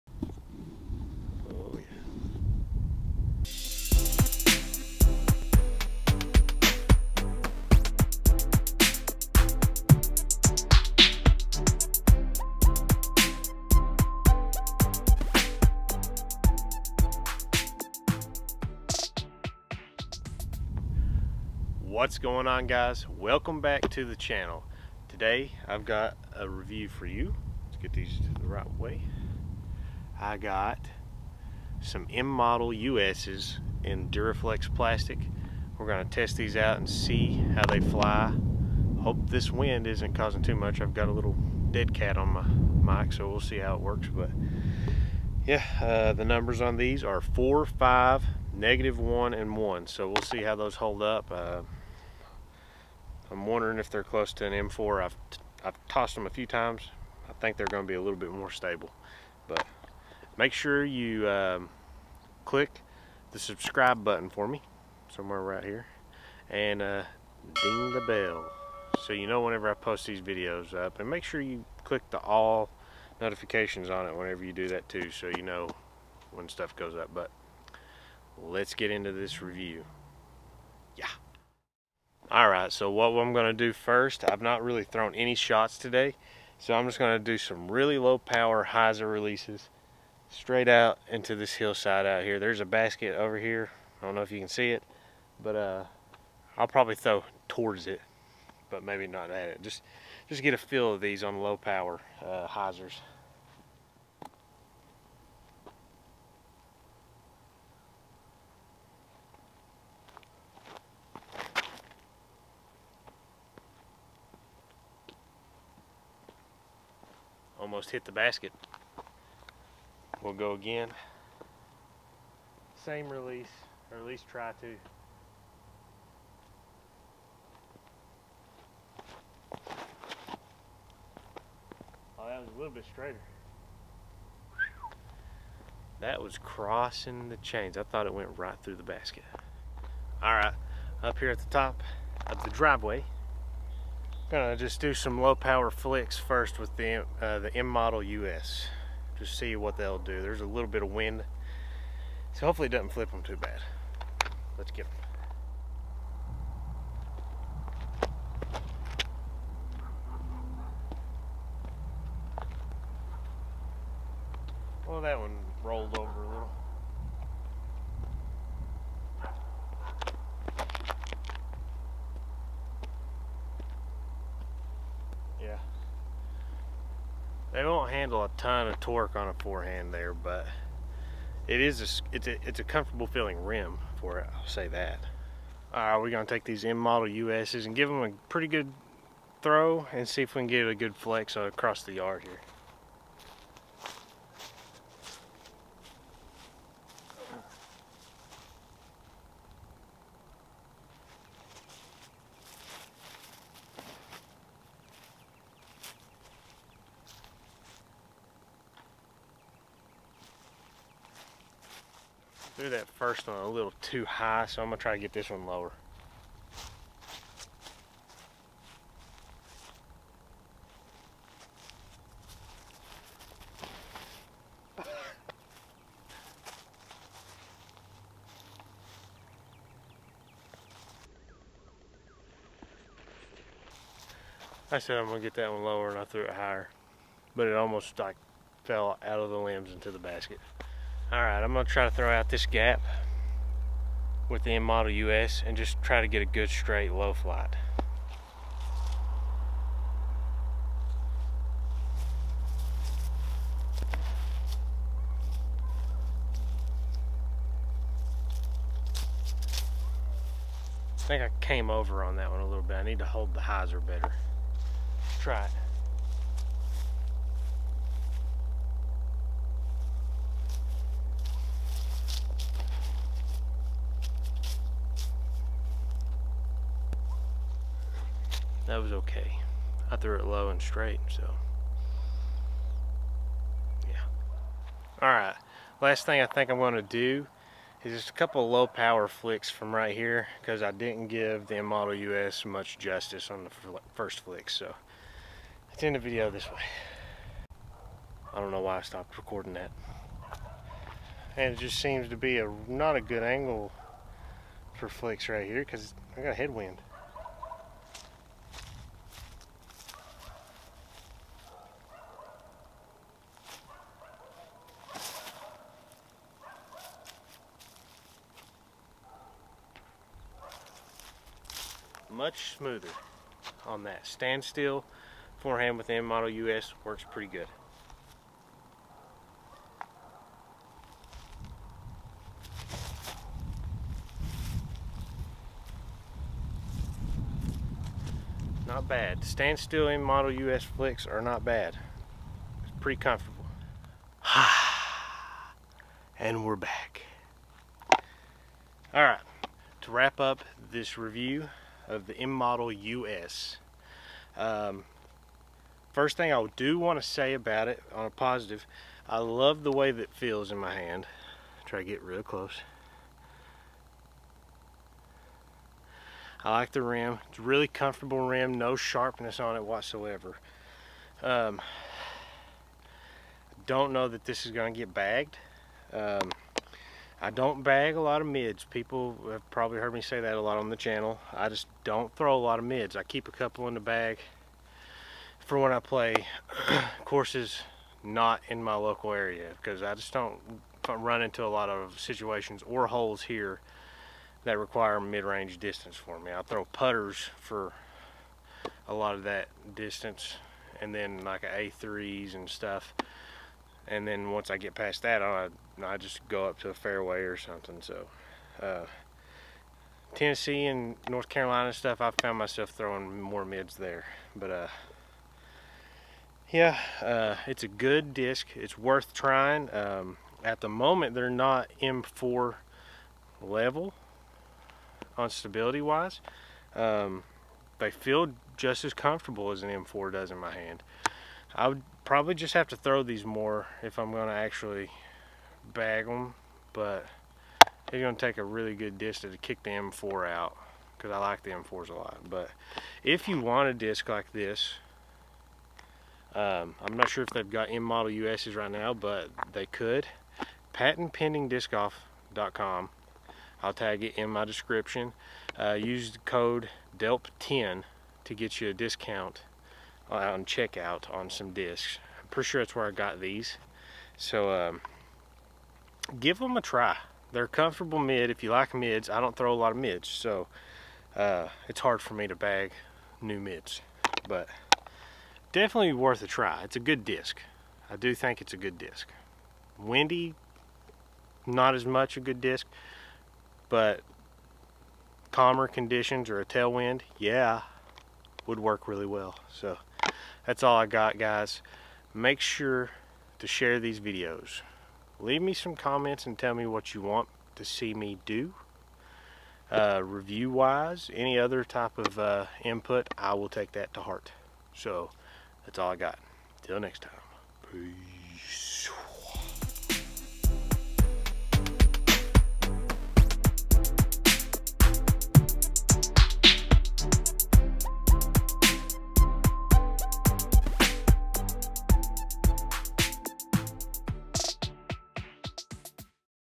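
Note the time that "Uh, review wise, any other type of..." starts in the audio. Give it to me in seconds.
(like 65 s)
499 s.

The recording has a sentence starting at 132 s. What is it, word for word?
Oh, that was a little bit straighter.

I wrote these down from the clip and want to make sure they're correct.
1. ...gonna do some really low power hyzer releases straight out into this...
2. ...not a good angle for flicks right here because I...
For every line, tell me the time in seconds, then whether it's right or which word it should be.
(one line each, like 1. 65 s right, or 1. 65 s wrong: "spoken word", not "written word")
1. 86 s right
2. 302 s right.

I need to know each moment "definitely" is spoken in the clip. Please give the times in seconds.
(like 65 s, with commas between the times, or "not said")
475 s.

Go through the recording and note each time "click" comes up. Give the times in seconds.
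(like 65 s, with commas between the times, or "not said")
62 s, 71 s.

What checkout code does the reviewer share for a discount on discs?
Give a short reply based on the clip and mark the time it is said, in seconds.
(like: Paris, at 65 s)
DELP10, at 456 s.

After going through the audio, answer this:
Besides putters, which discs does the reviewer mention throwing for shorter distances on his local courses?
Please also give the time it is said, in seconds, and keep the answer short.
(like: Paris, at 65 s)
A3s, at 401 s.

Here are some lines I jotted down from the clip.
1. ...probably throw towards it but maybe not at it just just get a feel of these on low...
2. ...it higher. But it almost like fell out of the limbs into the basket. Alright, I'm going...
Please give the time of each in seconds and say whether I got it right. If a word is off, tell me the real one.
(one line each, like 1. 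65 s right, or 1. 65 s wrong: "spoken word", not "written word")
1. 96 s right
2. 236 s right.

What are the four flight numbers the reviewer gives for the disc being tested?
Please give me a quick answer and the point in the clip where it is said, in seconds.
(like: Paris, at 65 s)
4, 5, -1, 1, at 47 s.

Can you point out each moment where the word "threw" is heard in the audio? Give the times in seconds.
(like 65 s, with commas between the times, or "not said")
212 s, 236 s, 279 s.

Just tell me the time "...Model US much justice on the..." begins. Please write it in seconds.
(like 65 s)
291 s.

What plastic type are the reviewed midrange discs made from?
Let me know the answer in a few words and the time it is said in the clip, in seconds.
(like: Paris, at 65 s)
Duraflex, at 34 s.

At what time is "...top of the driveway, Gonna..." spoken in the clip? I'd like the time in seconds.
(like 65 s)
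141 s.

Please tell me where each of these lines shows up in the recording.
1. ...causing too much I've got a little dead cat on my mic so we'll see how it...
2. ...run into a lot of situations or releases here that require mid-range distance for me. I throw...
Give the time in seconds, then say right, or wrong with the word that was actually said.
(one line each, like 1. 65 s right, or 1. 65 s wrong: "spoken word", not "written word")
1. 40 s right
2. 390 s wrong: "holes", not "releases".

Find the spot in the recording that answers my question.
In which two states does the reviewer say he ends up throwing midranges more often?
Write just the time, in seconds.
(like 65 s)
410 s.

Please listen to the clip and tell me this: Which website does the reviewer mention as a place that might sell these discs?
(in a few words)
PatentPendingDiscGolf.com.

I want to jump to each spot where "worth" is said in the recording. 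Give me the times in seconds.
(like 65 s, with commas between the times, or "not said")
418 s, 475 s.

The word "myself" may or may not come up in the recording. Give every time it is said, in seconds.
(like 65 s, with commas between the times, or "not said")
412 s.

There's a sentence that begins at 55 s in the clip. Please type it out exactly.
I've, I've tossed them a few times.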